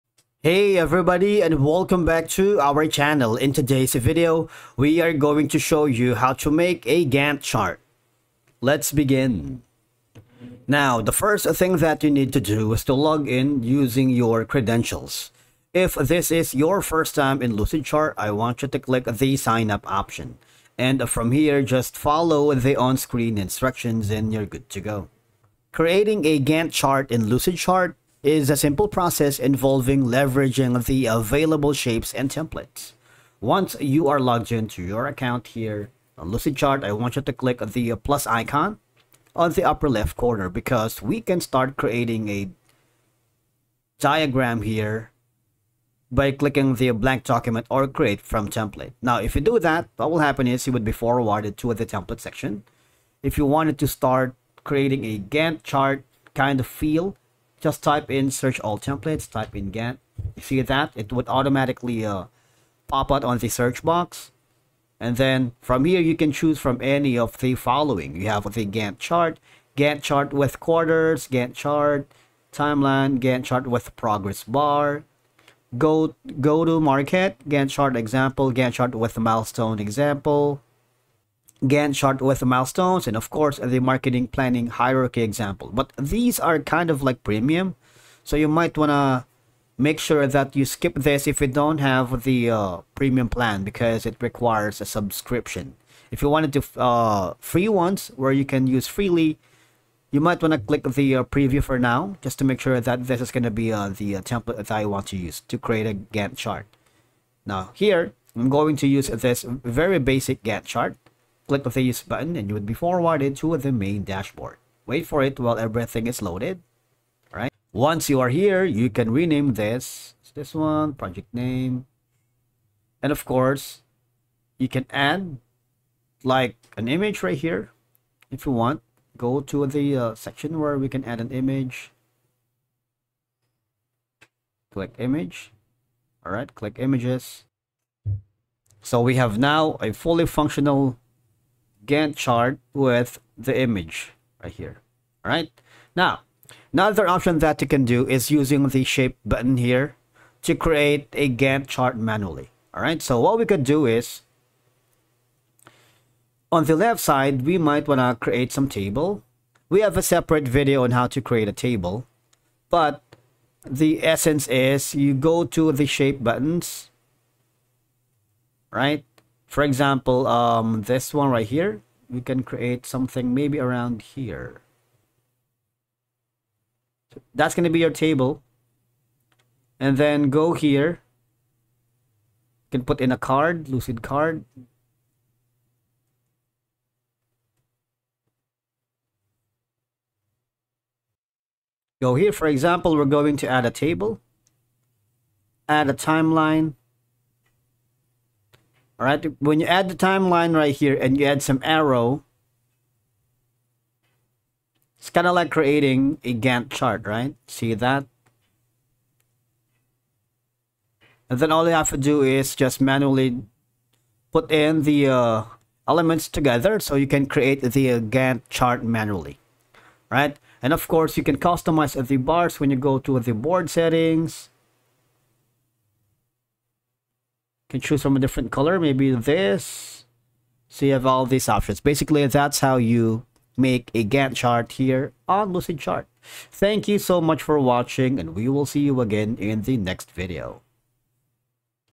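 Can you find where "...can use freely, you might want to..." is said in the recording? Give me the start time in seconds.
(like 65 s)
98 s.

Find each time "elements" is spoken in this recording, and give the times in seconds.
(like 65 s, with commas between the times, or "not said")
215 s.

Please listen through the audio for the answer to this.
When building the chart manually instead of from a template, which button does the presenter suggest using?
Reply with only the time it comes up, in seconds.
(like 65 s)
148 s.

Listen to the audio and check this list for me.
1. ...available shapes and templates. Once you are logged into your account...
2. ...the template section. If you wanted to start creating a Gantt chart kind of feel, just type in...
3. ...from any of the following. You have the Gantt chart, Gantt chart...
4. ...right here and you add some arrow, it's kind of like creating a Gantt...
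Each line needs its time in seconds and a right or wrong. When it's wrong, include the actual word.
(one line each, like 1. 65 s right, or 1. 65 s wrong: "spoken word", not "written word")
1. 31 s right
2. 51 s right
3. 66 s right
4. 200 s right.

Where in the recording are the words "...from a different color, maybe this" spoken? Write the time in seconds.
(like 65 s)
228 s.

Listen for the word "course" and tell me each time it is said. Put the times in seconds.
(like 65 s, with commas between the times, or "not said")
83 s, 123 s, 220 s.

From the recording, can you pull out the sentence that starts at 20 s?
And from here, just follow the on-screen instructions and you're good to go.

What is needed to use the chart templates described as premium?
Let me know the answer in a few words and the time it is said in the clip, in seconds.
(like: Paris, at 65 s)
A subscription, at 94 s.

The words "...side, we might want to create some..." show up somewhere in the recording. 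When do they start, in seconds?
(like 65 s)
157 s.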